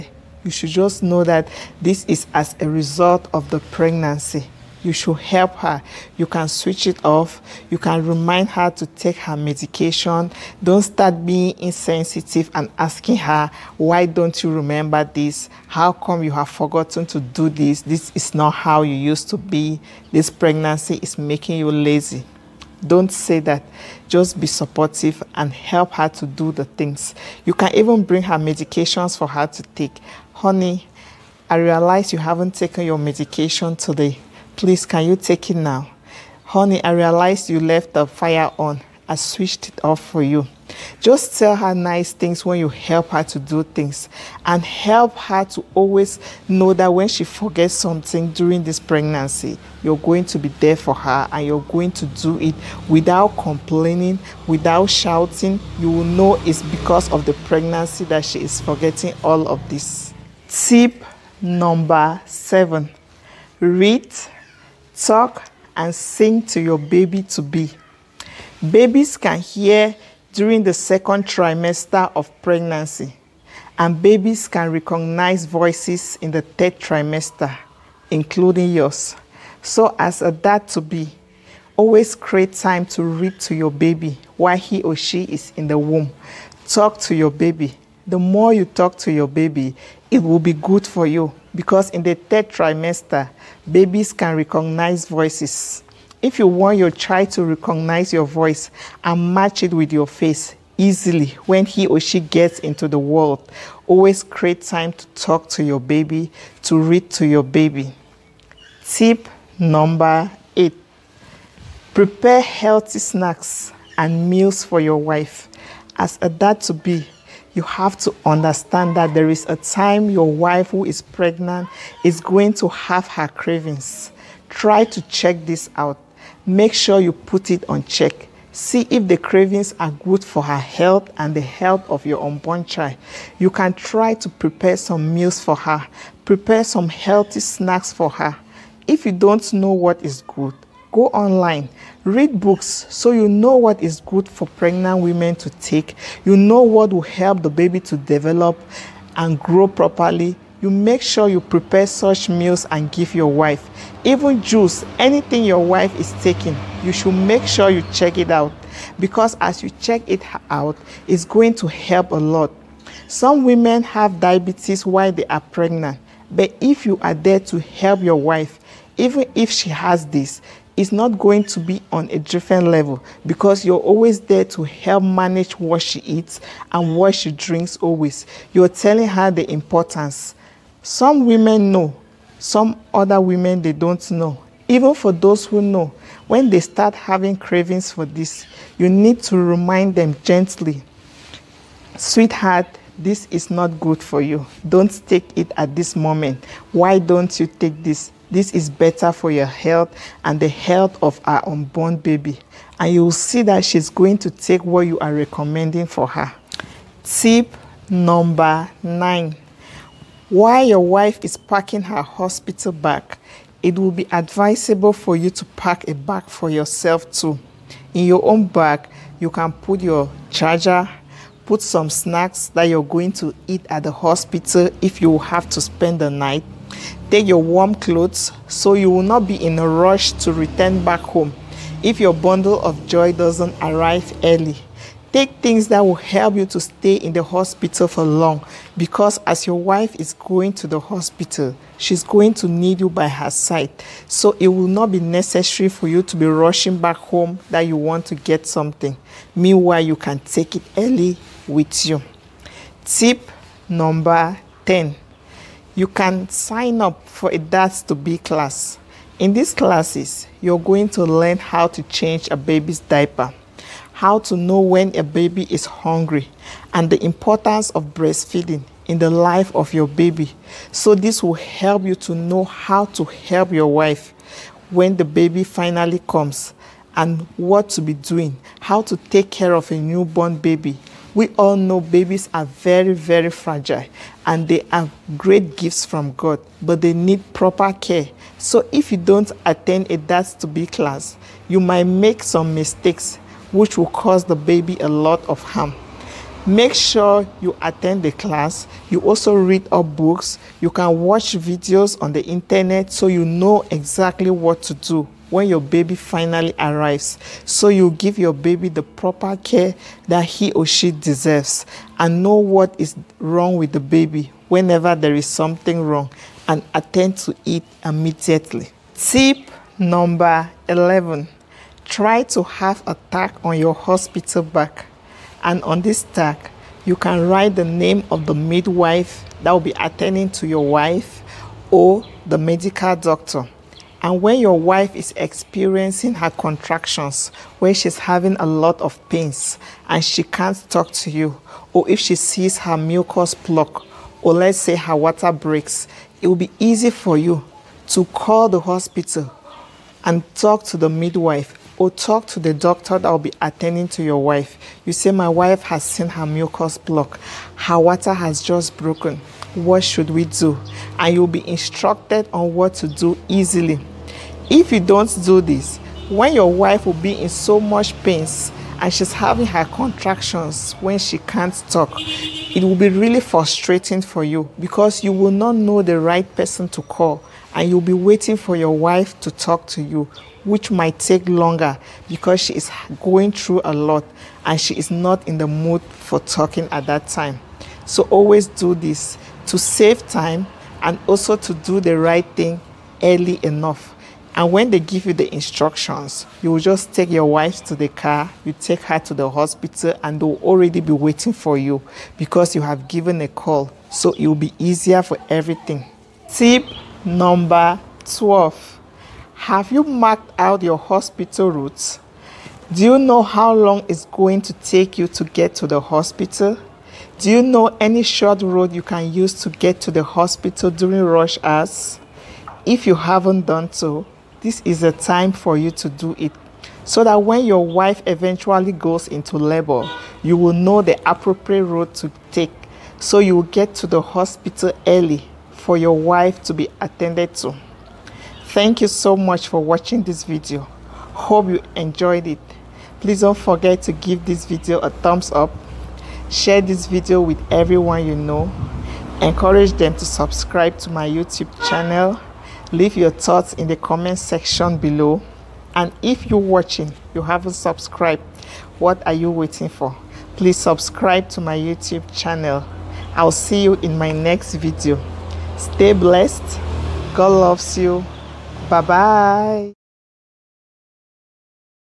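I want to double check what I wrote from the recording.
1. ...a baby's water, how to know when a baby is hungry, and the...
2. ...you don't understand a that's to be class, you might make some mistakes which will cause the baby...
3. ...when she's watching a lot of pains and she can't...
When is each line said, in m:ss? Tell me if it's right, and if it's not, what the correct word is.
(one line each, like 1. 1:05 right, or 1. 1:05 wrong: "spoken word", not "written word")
1. 4:22 wrong: "diaper", not "water"
2. 4:48 wrong: "attend", not "understand"
3. 5:37 wrong: "having", not "watching".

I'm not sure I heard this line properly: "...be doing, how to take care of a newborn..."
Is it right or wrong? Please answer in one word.
right.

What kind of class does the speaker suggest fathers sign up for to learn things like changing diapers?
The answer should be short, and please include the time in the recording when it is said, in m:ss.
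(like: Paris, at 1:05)
Dads to be class, at 4:17.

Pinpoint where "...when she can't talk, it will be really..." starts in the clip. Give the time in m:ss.
6:10.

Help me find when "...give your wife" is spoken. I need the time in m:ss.
2:32.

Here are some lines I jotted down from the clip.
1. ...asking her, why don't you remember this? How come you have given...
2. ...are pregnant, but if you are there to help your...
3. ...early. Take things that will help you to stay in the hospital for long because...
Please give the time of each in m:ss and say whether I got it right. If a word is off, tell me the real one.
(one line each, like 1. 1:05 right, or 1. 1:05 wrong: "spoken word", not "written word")
1. 0:12 wrong: "forgotten", not "given"
2. 2:45 right
3. 3:54 right.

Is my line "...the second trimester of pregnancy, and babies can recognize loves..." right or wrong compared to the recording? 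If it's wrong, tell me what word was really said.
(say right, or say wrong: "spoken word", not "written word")
wrong: "voices", not "loves".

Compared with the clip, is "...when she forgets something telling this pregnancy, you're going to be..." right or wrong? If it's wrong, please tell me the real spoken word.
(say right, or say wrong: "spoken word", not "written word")
wrong: "during", not "telling".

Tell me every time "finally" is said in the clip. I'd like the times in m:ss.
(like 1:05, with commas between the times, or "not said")
4:35, 5:05.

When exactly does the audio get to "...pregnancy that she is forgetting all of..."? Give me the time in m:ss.
0:57.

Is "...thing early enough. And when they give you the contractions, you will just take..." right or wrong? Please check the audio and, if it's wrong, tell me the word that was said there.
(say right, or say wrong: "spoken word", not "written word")
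wrong: "instructions", not "contractions".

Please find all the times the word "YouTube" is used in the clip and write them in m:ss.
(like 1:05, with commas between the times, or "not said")
7:31, 7:41.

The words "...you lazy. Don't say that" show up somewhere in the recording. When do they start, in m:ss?
0:21.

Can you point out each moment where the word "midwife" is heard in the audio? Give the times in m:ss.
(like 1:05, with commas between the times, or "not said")
5:28, 5:50.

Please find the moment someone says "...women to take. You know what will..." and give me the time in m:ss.
2:25.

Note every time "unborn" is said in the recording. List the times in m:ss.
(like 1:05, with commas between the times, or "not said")
2:12, 3:21.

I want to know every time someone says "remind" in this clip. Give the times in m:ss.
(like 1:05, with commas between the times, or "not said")
0:08, 3:09.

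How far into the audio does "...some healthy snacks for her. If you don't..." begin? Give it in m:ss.
2:16.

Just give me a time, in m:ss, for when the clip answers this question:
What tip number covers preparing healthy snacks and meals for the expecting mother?
1:50.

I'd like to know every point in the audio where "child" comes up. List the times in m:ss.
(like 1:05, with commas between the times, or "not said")
1:36, 2:12.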